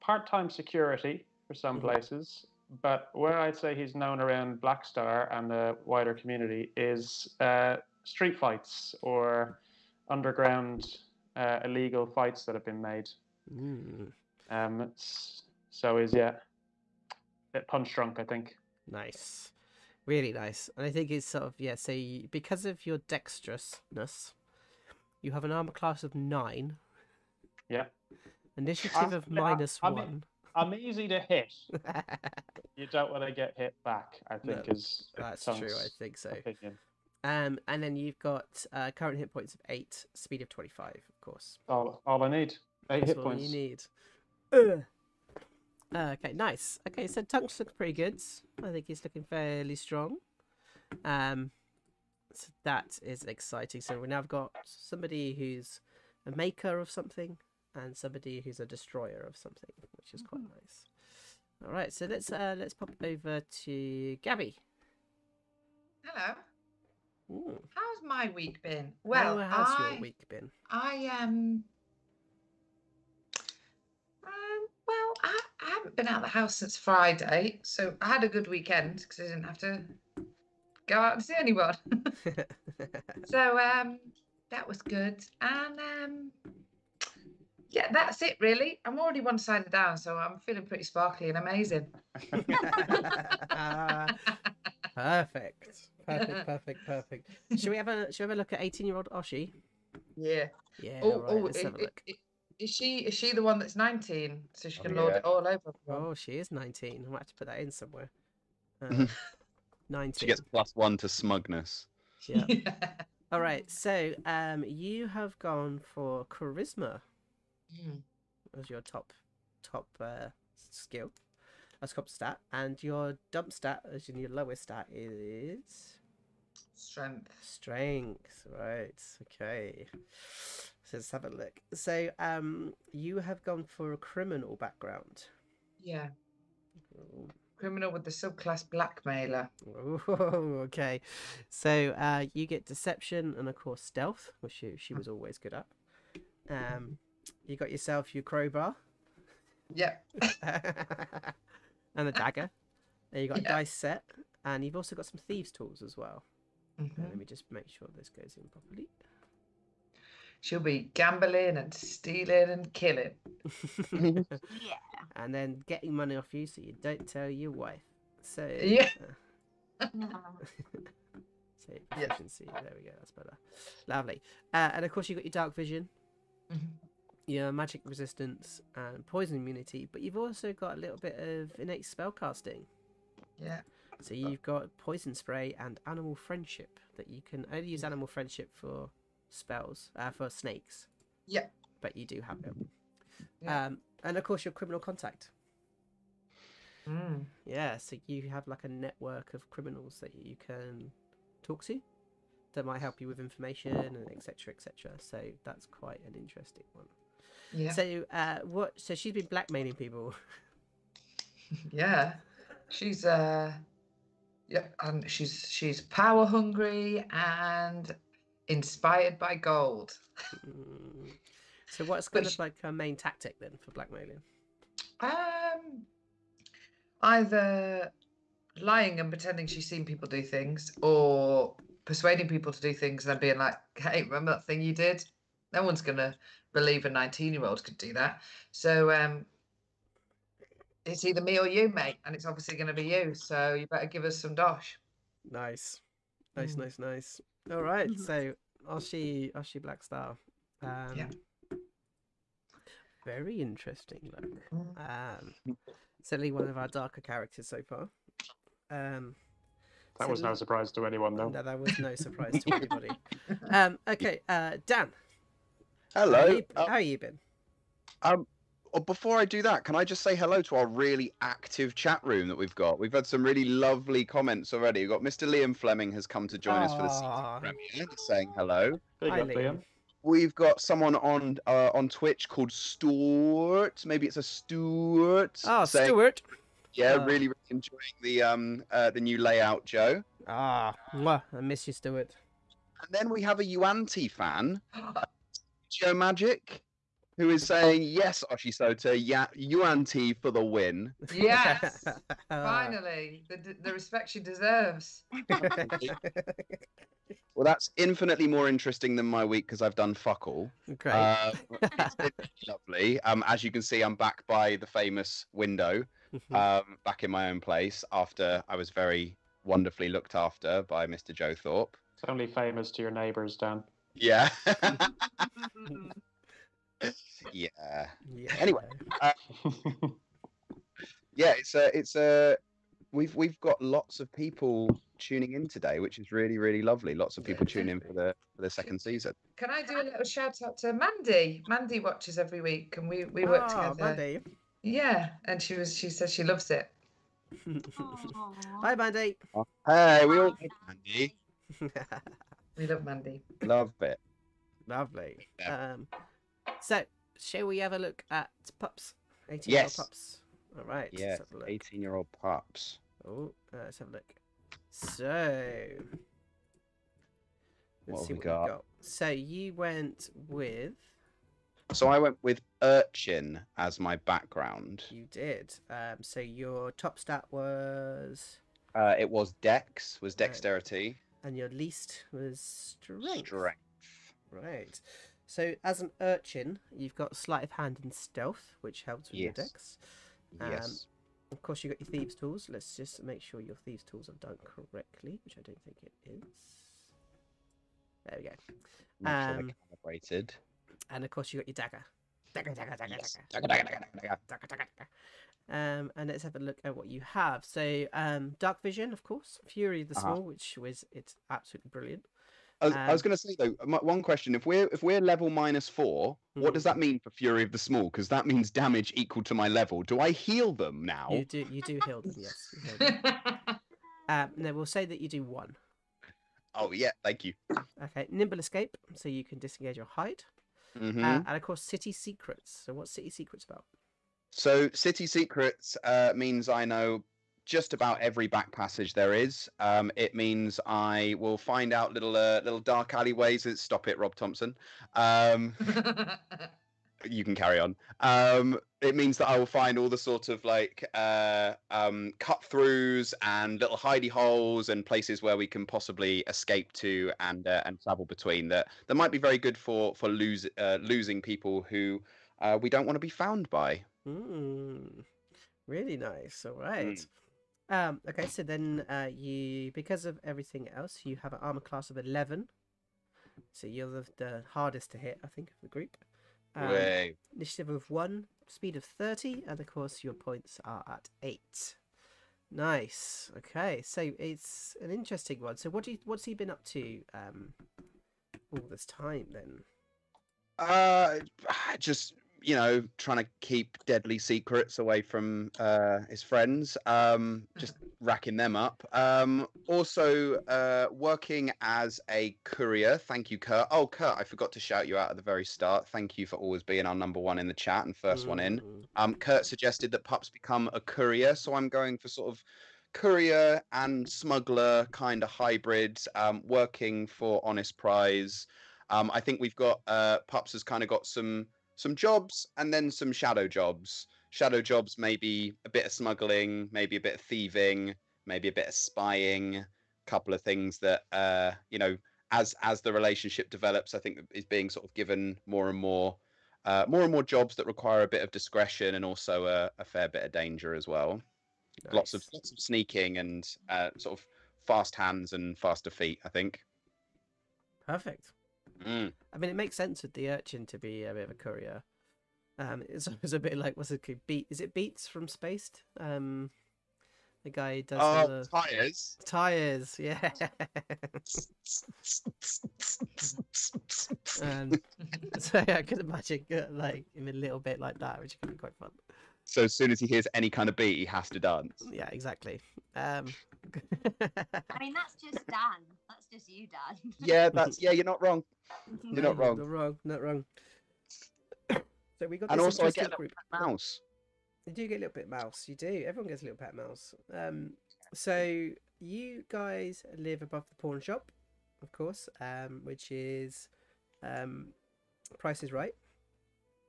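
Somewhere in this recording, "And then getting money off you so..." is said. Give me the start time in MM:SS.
02:45.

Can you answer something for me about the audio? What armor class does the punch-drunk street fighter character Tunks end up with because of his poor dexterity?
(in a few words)
9.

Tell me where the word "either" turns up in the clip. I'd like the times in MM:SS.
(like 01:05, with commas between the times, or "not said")
03:47, 04:01.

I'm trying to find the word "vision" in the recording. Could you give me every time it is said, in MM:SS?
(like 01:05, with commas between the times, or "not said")
02:55, 06:48.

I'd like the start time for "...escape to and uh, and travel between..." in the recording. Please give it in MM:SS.
07:36.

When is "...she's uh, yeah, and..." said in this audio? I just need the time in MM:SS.
03:32.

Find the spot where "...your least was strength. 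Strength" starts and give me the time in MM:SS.
06:21.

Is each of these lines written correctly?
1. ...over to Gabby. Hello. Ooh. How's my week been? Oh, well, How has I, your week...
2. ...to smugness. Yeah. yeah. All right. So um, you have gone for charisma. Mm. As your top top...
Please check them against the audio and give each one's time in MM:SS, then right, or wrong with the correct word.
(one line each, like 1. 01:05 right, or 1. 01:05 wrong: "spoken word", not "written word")
1. 01:03 right
2. 01:50 right.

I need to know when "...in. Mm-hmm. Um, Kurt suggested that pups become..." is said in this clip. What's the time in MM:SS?
08:28.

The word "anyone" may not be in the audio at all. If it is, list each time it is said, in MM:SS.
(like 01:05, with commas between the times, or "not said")
01:21, 04:20.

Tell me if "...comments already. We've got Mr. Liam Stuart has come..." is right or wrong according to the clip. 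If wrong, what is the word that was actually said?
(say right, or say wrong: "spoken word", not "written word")
wrong: "Fleming", not "Stuart".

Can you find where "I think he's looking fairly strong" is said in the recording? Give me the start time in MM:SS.
00:48.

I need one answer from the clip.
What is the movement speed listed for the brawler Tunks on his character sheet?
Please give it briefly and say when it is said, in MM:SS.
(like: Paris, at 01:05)
25, at 00:40.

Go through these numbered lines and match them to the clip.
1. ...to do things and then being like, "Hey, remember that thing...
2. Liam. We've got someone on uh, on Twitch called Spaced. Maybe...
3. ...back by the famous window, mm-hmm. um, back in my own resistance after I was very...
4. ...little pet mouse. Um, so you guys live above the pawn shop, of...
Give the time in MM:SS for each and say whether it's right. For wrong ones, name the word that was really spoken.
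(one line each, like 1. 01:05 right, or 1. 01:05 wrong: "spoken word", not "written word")
1. 03:52 right
2. 04:39 wrong: "Stuart", not "Spaced"
3. 05:13 wrong: "place", not "resistance"
4. 09:46 right.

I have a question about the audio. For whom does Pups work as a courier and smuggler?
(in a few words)
Honest Price.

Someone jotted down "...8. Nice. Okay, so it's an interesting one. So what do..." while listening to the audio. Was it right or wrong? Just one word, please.
right.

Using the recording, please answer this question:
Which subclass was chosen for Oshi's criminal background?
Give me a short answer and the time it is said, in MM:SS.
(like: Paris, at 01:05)
Blackmailer, at 02:18.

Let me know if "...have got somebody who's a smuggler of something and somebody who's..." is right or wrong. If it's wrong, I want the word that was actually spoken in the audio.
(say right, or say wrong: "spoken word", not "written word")
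wrong: "maker", not "smuggler".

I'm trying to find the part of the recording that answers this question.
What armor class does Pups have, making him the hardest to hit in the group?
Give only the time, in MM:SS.
07:51.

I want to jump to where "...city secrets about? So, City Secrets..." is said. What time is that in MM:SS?
07:12.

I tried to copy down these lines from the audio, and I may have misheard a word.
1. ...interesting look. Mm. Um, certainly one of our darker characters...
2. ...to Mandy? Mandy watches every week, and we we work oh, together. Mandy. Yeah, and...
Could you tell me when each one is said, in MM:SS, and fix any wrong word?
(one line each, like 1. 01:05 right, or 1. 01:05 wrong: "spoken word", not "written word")
1. 04:13 right
2. 05:40 right.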